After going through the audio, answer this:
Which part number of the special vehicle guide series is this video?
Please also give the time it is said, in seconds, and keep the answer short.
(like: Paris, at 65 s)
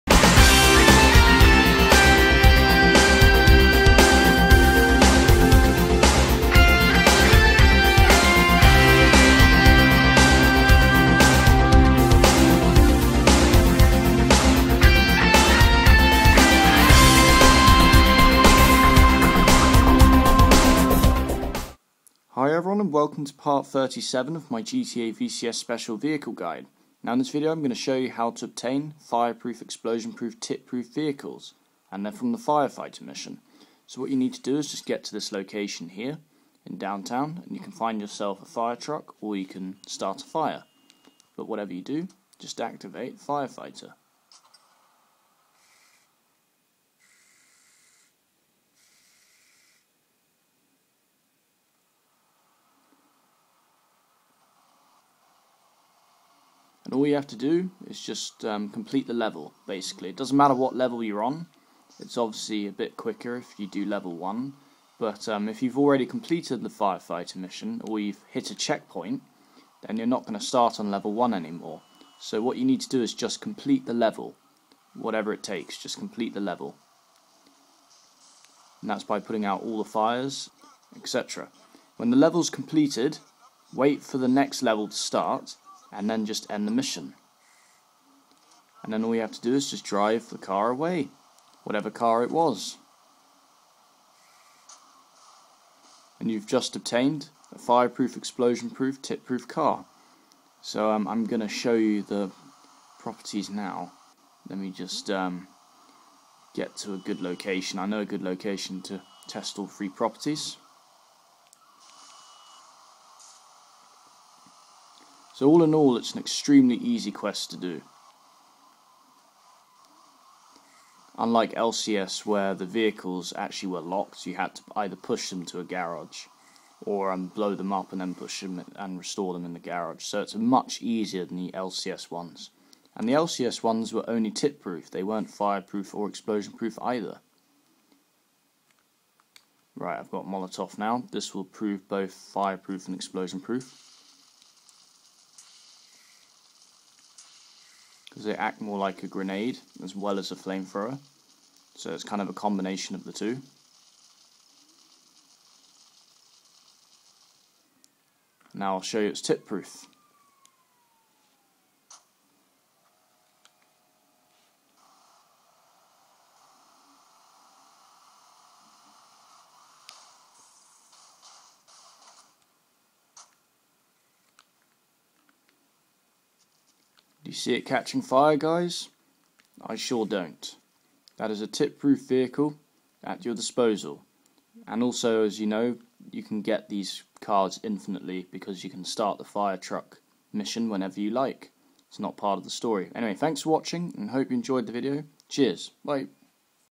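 37, at 23 s.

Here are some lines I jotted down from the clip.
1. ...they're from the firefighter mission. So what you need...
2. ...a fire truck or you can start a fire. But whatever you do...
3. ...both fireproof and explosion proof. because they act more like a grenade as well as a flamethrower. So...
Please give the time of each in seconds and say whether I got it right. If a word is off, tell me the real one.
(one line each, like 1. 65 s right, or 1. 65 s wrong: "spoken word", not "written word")
1. 32 s right
2. 38 s right
3. 141 s right.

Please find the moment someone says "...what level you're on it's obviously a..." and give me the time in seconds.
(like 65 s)
60 s.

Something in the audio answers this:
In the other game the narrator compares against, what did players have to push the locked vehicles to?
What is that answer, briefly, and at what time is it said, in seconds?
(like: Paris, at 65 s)
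a garage, at 125 s.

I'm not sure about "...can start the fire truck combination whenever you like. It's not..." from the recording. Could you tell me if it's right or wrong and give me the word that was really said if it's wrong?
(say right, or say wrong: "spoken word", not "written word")
wrong: "mission", not "combination".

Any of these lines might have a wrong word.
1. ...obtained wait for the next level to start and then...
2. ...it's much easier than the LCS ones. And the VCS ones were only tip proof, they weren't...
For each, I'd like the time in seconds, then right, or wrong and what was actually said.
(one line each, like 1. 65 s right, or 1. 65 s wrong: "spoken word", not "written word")
1. 82 s wrong: "completed", not "obtained"
2. 130 s wrong: "LCS", not "VCS".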